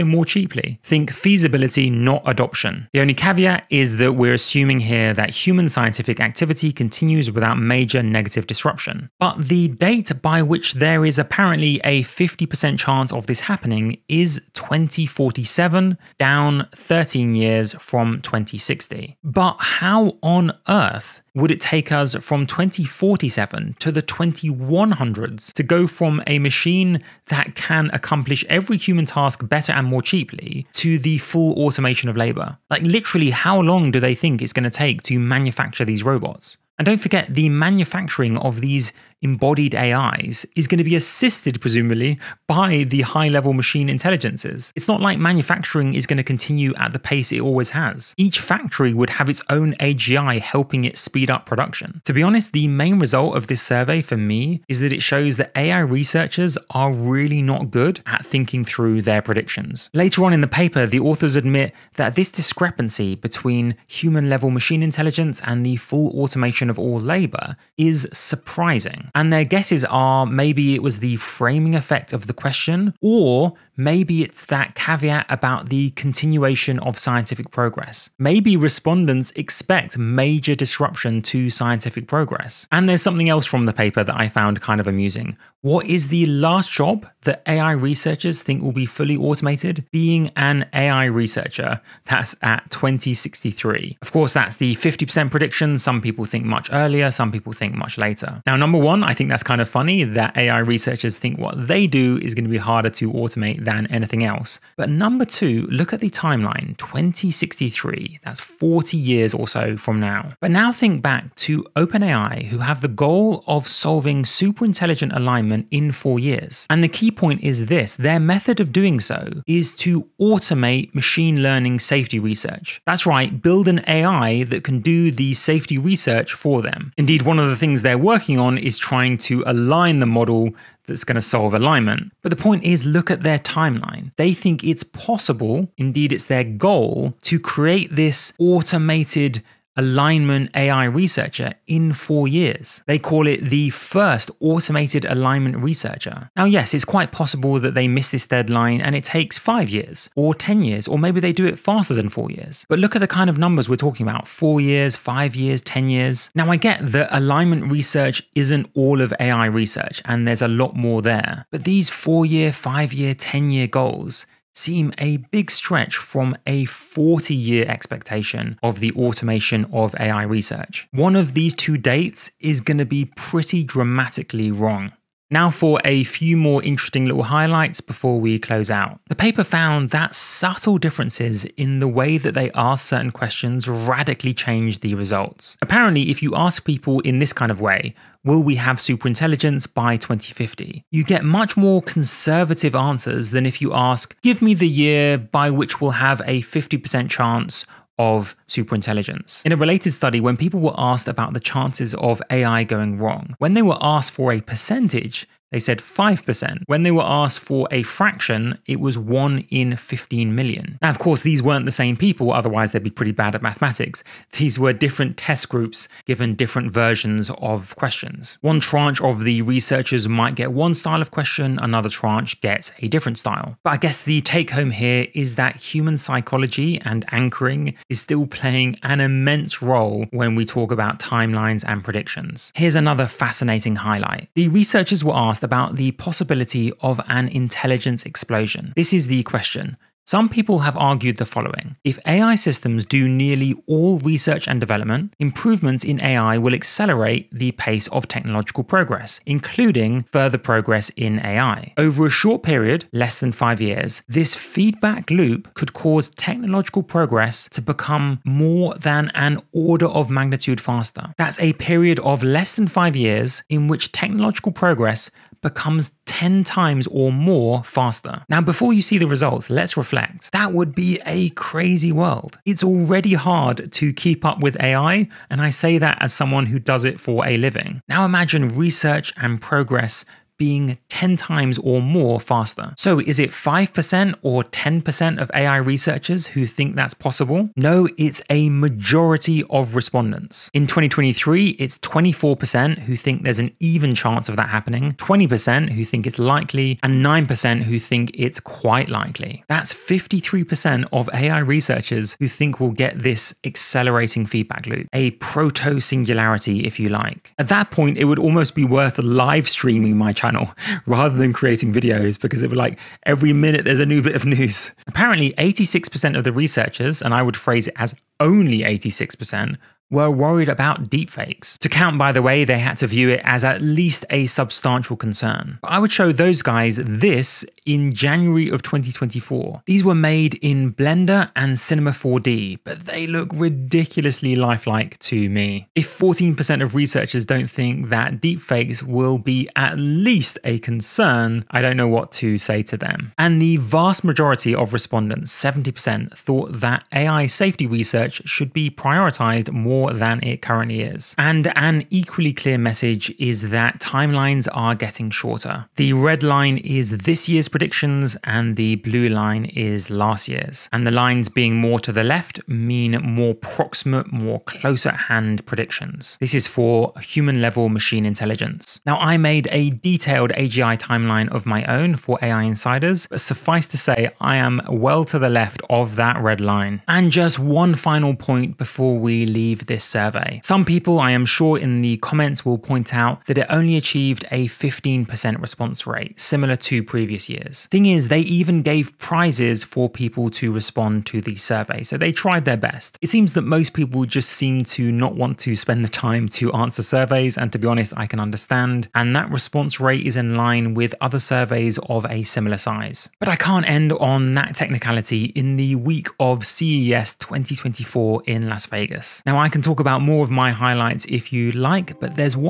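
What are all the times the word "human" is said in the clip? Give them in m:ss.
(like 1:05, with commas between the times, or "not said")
0:05, 0:28, 1:03, 3:45, 6:07.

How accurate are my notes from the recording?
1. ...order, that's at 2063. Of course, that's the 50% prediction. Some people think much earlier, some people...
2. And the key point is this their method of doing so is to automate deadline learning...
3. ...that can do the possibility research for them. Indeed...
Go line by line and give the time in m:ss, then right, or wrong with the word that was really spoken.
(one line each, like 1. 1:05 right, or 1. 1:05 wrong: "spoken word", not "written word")
1. 1:31 wrong: "researcher", not "order"
2. 1:56 wrong: "machine", not "deadline"
3. 2:04 wrong: "safety", not "possibility".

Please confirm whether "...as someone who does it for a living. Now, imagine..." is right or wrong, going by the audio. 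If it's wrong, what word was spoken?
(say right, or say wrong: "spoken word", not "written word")
right.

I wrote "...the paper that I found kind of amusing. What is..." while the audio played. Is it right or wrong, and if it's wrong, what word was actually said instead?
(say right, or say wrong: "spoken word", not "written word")
right.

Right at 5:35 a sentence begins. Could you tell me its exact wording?
If 14% of researchers don't think that deepfakes will be at least a concern, I don't know what to say to them.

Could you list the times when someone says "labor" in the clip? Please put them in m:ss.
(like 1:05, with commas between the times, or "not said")
0:32, 1:06.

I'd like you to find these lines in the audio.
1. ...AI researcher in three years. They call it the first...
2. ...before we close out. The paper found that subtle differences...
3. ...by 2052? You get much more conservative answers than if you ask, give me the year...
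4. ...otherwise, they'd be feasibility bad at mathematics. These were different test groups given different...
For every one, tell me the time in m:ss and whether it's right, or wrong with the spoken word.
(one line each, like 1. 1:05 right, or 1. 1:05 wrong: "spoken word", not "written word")
1. 2:20 wrong: "four", not "three"
2. 2:57 right
3. 3:09 wrong: "2050", not "2052"
4. 3:32 wrong: "pretty", not "feasibility".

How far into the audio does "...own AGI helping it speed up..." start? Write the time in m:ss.
0:49.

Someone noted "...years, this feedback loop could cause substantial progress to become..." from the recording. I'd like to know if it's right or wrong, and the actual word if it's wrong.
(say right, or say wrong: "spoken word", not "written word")
wrong: "technological", not "substantial".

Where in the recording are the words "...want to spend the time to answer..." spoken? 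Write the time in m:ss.
6:35.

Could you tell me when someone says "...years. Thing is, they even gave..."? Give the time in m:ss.
6:27.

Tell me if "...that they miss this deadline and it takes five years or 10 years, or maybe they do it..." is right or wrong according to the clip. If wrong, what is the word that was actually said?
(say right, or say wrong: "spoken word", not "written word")
right.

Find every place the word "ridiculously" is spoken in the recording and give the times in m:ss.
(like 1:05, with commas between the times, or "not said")
5:33.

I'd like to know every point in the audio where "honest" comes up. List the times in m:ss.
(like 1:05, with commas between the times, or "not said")
0:52, 6:37.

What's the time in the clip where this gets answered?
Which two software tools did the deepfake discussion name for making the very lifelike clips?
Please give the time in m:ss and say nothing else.
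5:30.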